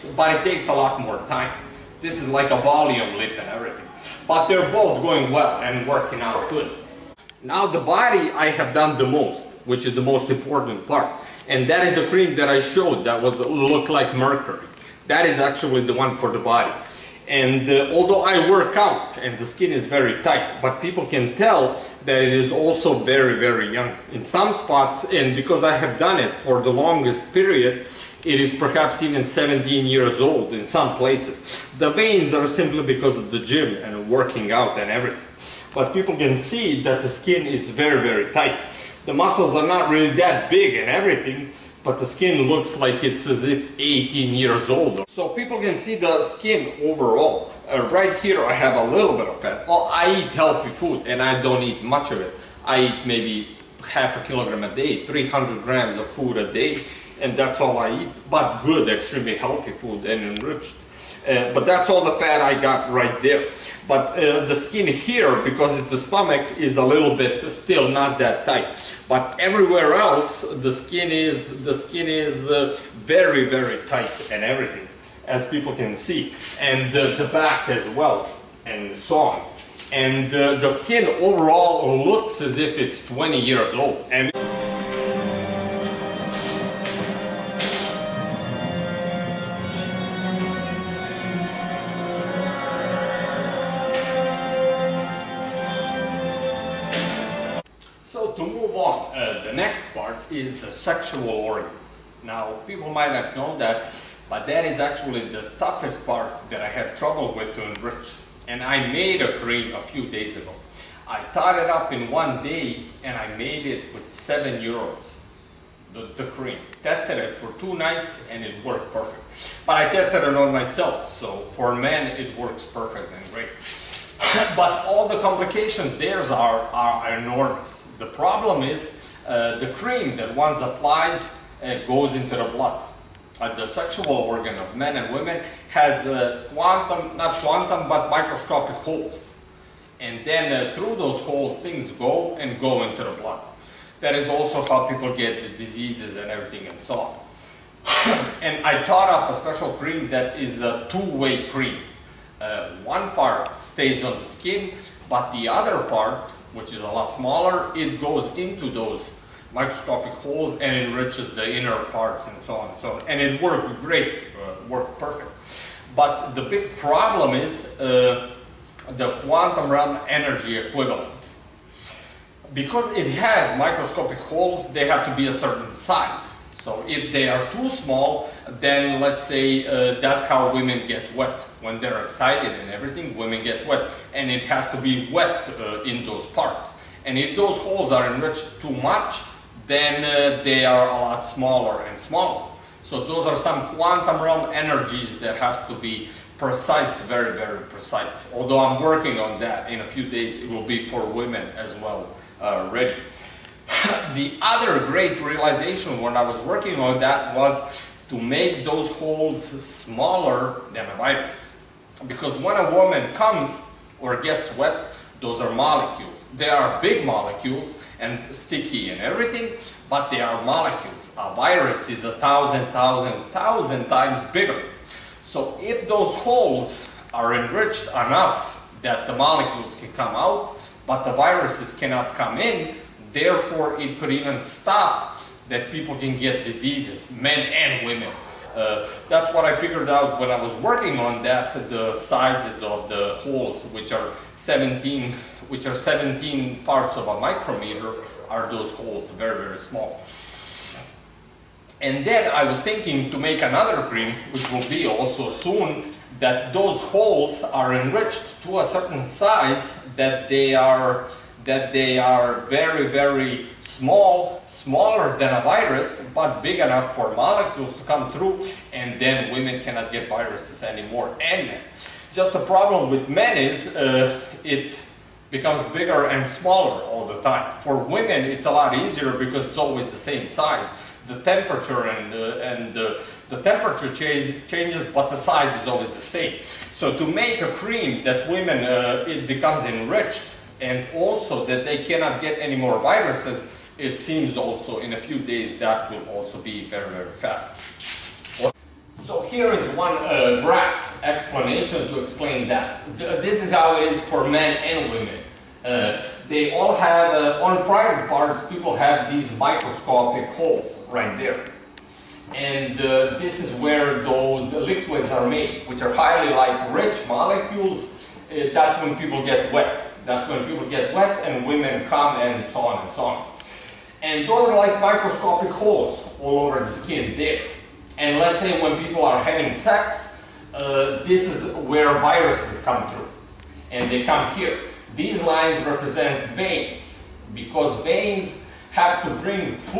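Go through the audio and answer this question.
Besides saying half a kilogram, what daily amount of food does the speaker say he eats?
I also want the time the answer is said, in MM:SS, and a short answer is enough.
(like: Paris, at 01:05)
300 grams, at 00:55.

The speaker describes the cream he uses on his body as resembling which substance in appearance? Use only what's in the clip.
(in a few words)
mercury.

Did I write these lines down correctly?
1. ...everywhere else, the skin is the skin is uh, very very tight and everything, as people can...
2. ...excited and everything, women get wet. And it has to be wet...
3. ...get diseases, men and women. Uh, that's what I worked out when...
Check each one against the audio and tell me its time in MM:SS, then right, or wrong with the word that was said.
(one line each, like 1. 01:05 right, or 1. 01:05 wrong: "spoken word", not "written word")
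1. 01:09 right
2. 03:02 right
3. 03:56 wrong: "figured", not "worked".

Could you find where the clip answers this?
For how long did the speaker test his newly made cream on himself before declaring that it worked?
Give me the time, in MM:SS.
01:57.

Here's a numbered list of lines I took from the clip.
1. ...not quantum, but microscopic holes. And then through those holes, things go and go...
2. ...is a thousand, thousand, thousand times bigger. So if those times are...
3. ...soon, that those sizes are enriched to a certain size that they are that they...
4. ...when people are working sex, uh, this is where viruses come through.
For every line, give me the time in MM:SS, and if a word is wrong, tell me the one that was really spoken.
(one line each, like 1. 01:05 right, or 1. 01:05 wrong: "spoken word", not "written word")
1. 02:17 right
2. 03:41 wrong: "holes", not "times"
3. 04:15 wrong: "holes", not "sizes"
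4. 05:28 wrong: "having", not "working".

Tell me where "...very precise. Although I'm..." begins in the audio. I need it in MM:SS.
03:17.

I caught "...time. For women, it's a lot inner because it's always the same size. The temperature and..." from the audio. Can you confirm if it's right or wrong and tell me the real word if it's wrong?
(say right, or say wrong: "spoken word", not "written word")
wrong: "easier", not "inner".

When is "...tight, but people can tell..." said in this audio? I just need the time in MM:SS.
00:20.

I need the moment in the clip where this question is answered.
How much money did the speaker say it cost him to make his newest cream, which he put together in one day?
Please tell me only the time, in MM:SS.
01:54.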